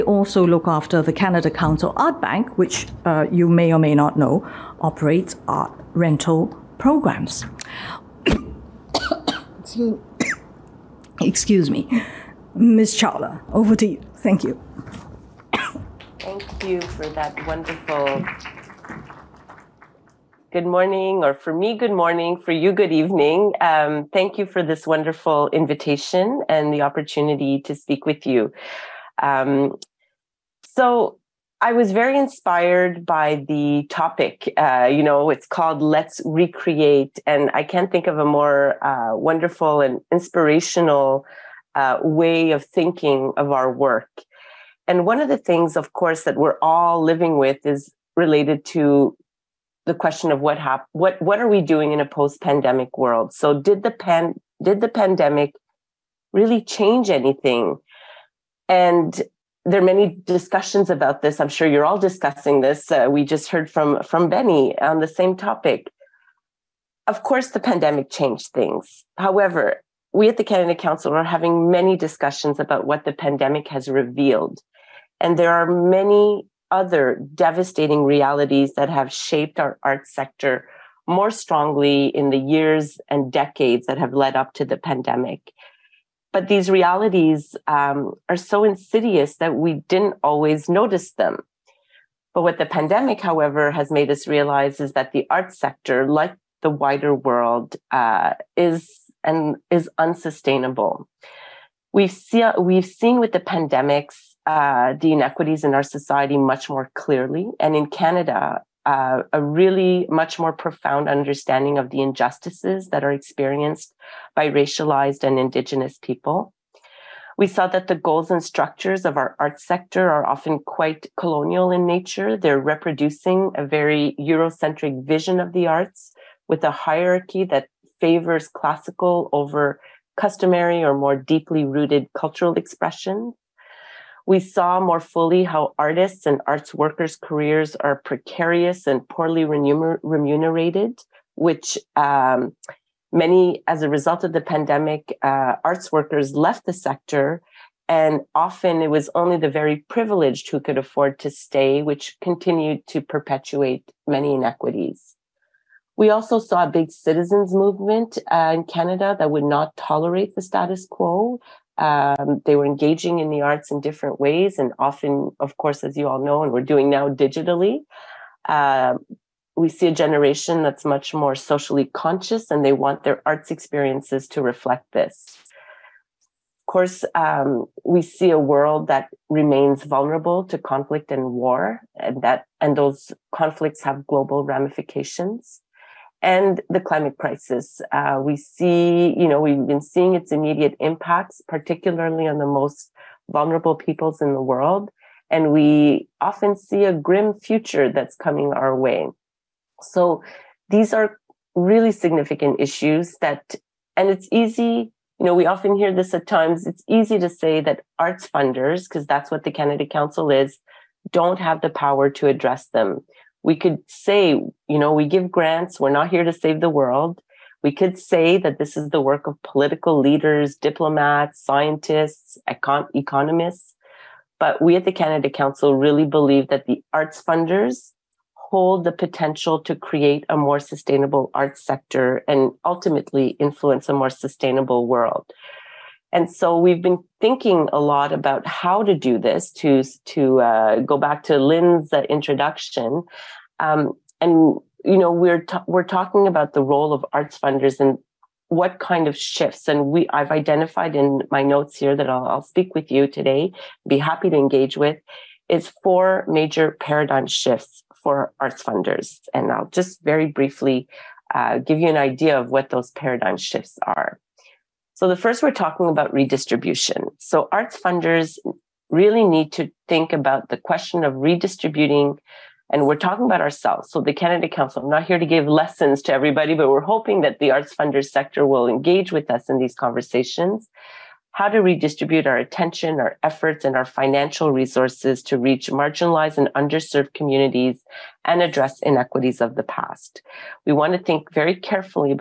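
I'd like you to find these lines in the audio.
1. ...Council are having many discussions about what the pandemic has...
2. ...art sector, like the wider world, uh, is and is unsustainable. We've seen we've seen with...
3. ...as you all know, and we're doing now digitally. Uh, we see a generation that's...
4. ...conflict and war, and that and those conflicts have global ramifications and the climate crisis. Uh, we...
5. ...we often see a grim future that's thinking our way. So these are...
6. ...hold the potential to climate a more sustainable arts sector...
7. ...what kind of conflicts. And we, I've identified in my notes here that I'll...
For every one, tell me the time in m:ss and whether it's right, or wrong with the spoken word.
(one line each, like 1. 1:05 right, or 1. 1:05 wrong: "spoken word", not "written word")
1. 1:10 right
2. 1:35 right
3. 2:45 right
4. 3:00 right
5. 3:15 wrong: "coming", not "thinking"
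6. 3:48 wrong: "create", not "climate"
7. 4:08 wrong: "shifts", not "conflicts".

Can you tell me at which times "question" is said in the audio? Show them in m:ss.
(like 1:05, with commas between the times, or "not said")
0:49, 4:30.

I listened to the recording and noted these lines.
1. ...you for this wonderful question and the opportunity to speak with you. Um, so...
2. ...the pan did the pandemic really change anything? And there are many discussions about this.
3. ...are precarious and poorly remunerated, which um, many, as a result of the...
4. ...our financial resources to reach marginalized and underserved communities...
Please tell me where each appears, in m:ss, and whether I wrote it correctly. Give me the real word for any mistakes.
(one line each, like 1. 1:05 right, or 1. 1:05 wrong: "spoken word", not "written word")
1. 0:24 wrong: "invitation", not "question"
2. 0:53 right
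3. 2:17 right
4. 4:43 right.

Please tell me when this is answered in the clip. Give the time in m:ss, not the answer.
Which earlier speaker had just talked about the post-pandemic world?
1:04.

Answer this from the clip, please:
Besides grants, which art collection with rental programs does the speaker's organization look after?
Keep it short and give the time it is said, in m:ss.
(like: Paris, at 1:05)
Canada Council Art Bank, at 0:01.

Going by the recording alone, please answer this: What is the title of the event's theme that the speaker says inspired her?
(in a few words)
Let's Recreate.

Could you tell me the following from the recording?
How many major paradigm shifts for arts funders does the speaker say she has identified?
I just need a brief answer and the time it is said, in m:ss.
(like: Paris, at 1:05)
4, at 4:15.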